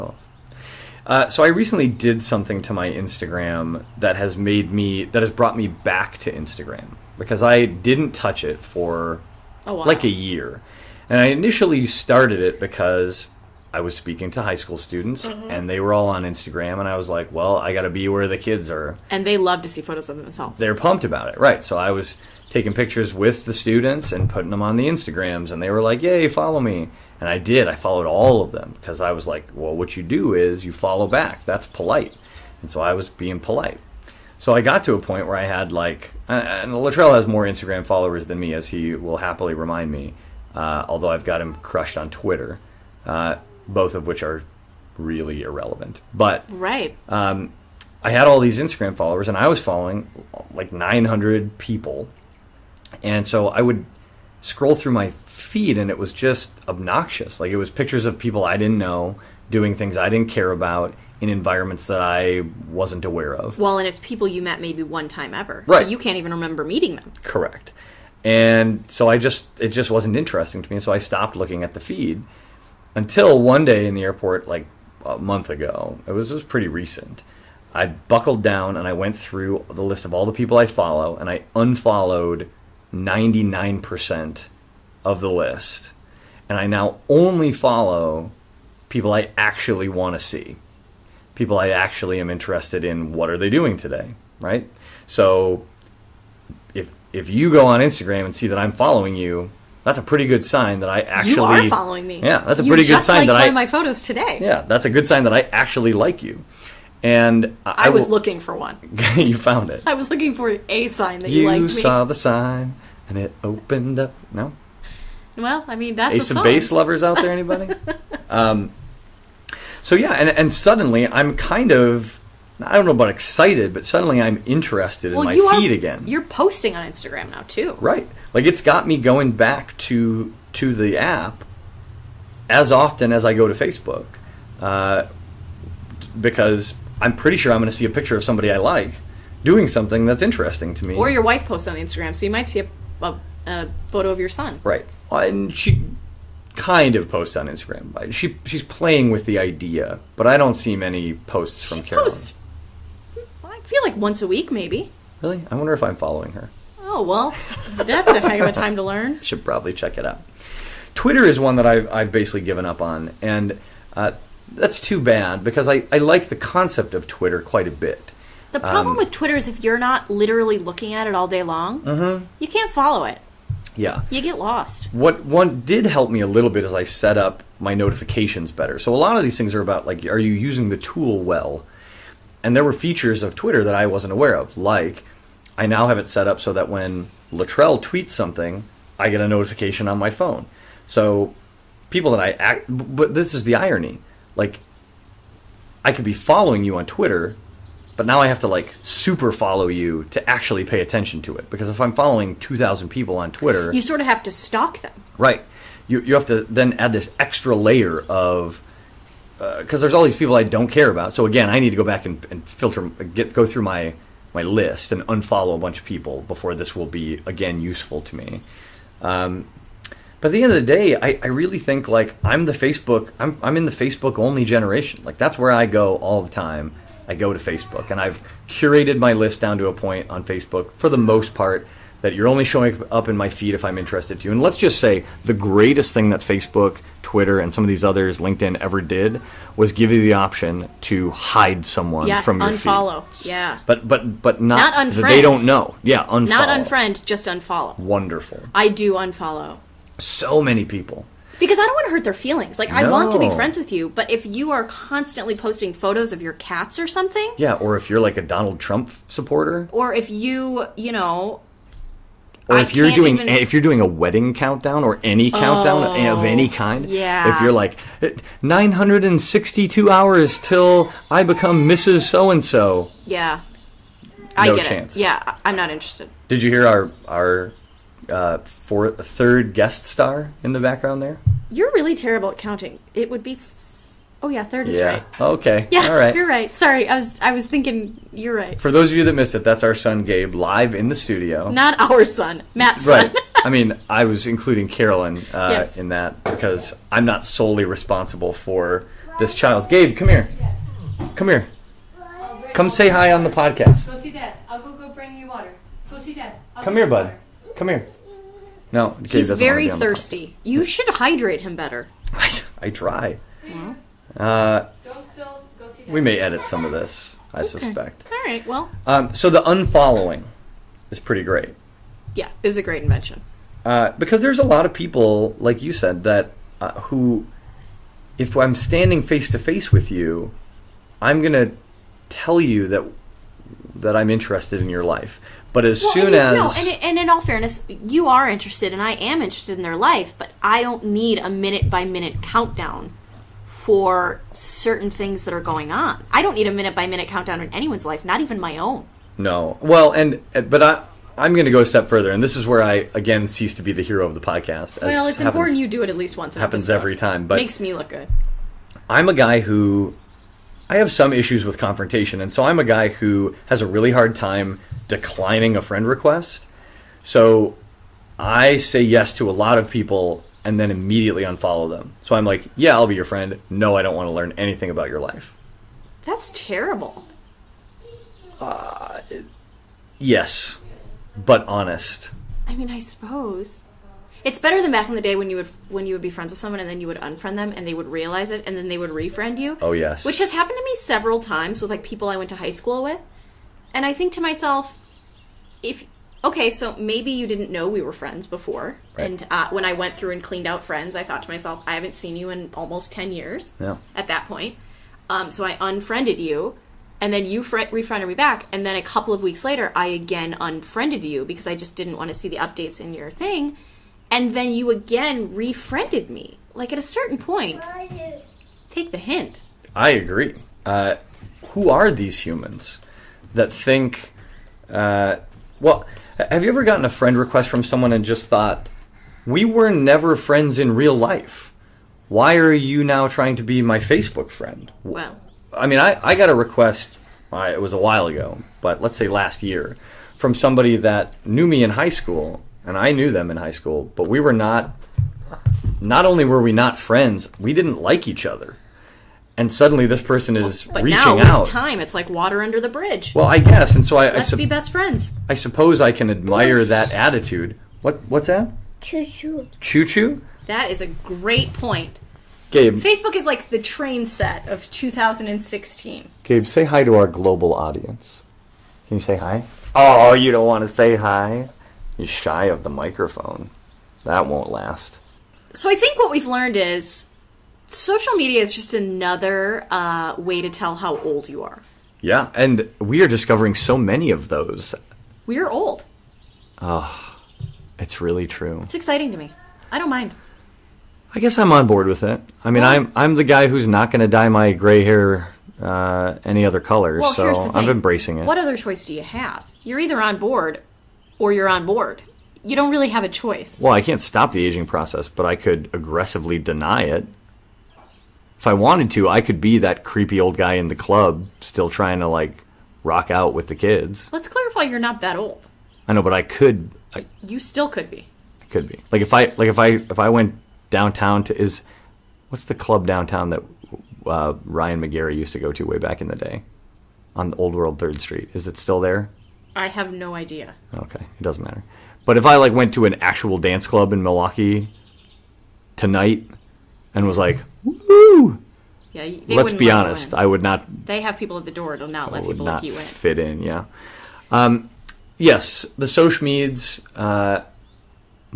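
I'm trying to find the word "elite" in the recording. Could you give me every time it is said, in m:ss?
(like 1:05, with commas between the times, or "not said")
not said.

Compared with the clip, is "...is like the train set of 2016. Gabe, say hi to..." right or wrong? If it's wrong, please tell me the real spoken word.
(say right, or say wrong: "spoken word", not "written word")
right.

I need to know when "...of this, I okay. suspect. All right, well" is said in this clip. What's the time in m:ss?
5:16.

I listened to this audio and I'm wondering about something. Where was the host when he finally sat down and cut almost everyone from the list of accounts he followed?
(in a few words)
the airport.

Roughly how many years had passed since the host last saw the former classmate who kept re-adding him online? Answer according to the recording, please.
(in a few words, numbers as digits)
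10 years.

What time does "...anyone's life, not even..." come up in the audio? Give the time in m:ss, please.
5:47.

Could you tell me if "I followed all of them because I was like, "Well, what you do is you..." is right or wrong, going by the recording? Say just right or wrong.
right.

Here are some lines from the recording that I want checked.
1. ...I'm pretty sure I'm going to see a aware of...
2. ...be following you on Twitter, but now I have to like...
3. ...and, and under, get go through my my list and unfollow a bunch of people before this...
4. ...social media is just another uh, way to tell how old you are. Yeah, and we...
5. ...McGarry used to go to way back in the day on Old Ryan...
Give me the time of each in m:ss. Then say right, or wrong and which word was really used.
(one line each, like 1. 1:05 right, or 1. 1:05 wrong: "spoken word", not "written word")
1. 2:17 wrong: "picture", not "aware"
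2. 3:16 right
3. 3:32 wrong: "filter", not "under"
4. 7:57 right
5. 8:44 wrong: "World", not "Ryan".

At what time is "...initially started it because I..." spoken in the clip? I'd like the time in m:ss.
0:11.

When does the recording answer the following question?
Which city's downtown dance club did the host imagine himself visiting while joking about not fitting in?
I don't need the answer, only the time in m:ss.
8:54.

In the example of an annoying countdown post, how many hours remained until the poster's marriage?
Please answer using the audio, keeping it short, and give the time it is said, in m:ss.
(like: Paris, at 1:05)
962, at 4:28.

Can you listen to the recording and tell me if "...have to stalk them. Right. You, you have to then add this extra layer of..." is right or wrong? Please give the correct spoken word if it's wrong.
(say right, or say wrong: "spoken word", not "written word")
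right.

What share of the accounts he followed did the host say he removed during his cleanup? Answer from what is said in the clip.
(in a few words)
99%.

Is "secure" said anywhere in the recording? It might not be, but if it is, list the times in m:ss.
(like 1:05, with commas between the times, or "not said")
not said.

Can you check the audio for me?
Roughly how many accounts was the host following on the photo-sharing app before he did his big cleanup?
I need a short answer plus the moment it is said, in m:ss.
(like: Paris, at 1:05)
900, at 0:50.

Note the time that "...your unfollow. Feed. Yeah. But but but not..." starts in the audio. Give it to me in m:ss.
4:02.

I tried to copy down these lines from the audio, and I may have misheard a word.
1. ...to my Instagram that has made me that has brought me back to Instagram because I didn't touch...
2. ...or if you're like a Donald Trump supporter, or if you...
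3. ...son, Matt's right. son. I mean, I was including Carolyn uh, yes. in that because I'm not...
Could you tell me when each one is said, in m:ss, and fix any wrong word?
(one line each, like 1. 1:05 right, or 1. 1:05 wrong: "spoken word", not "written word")
1. 0:02 right
2. 4:17 right
3. 4:52 right.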